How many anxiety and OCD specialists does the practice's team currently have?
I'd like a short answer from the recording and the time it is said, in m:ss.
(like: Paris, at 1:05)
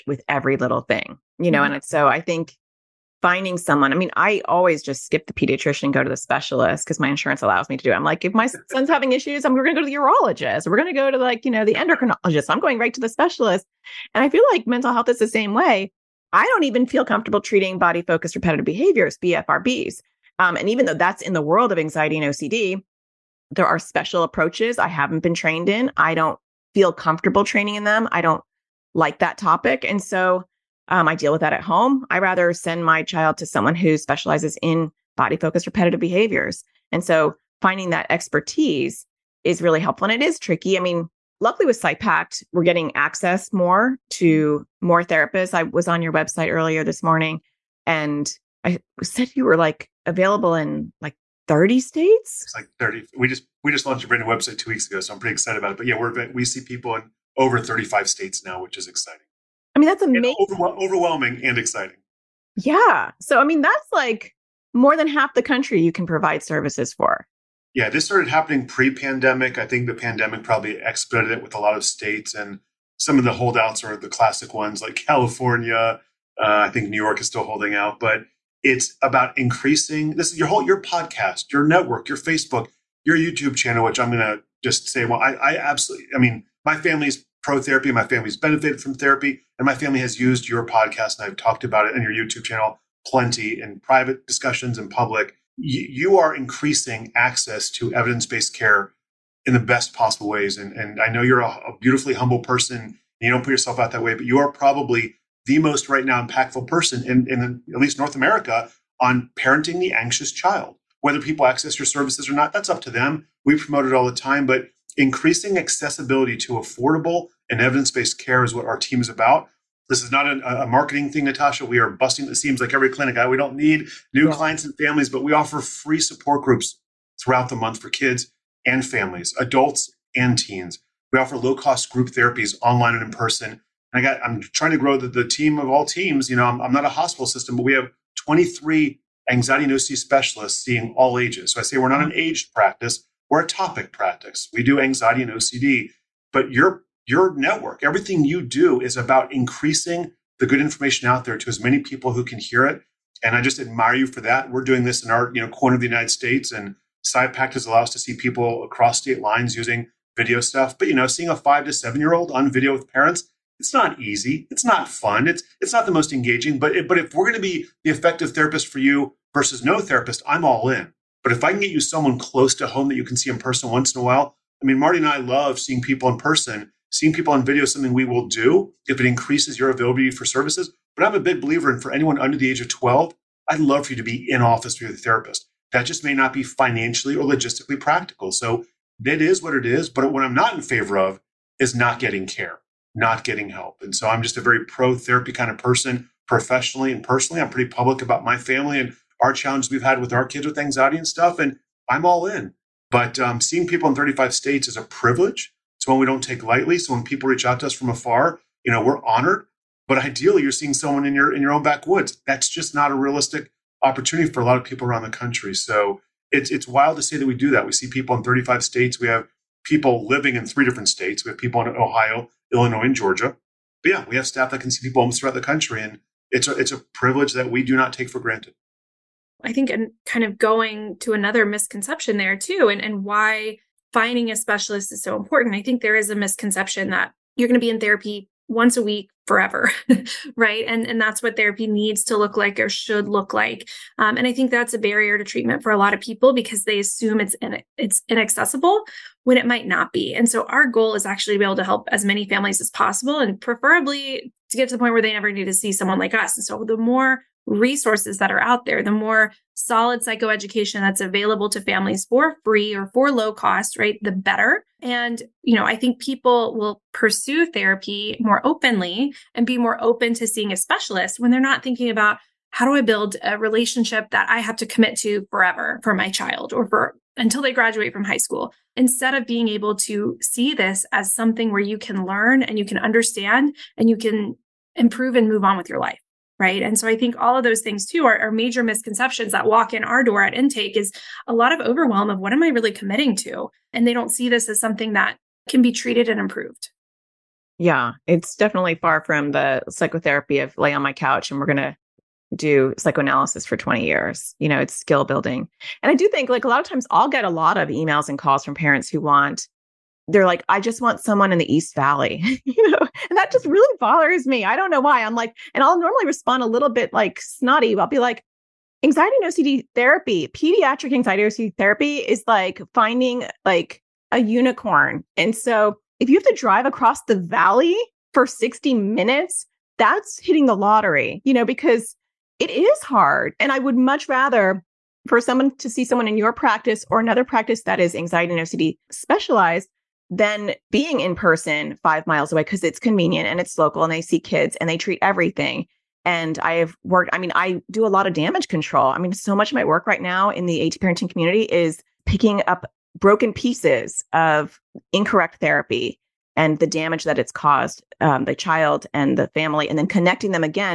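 23, at 2:18.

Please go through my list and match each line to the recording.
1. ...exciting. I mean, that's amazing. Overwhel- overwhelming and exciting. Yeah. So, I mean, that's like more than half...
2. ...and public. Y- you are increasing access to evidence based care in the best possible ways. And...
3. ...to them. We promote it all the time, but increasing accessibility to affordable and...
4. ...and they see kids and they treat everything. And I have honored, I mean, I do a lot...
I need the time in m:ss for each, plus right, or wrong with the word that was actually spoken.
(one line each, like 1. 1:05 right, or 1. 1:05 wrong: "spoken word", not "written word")
1. 0:58 right
2. 1:34 right
3. 1:52 right
4. 5:43 wrong: "worked", not "honored".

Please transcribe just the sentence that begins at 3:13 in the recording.
And so I'm just a very pro therapy kind of person professionally and personally.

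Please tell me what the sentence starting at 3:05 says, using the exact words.
That just may not be financially or logistically practical.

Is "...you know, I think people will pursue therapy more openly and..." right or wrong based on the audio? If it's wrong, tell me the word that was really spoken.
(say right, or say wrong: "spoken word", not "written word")
right.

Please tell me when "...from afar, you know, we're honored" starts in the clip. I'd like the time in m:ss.
3:27.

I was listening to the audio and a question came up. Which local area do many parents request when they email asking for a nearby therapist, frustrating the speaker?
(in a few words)
East Valley.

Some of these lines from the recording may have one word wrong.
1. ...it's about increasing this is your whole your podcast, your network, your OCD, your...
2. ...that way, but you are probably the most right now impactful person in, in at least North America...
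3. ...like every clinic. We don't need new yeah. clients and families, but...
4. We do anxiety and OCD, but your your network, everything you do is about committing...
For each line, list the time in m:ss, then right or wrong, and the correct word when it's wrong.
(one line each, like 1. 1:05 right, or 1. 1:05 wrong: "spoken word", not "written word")
1. 1:18 wrong: "Facebook", not "OCD"
2. 1:43 right
3. 2:02 right
4. 2:24 wrong: "increasing", not "committing".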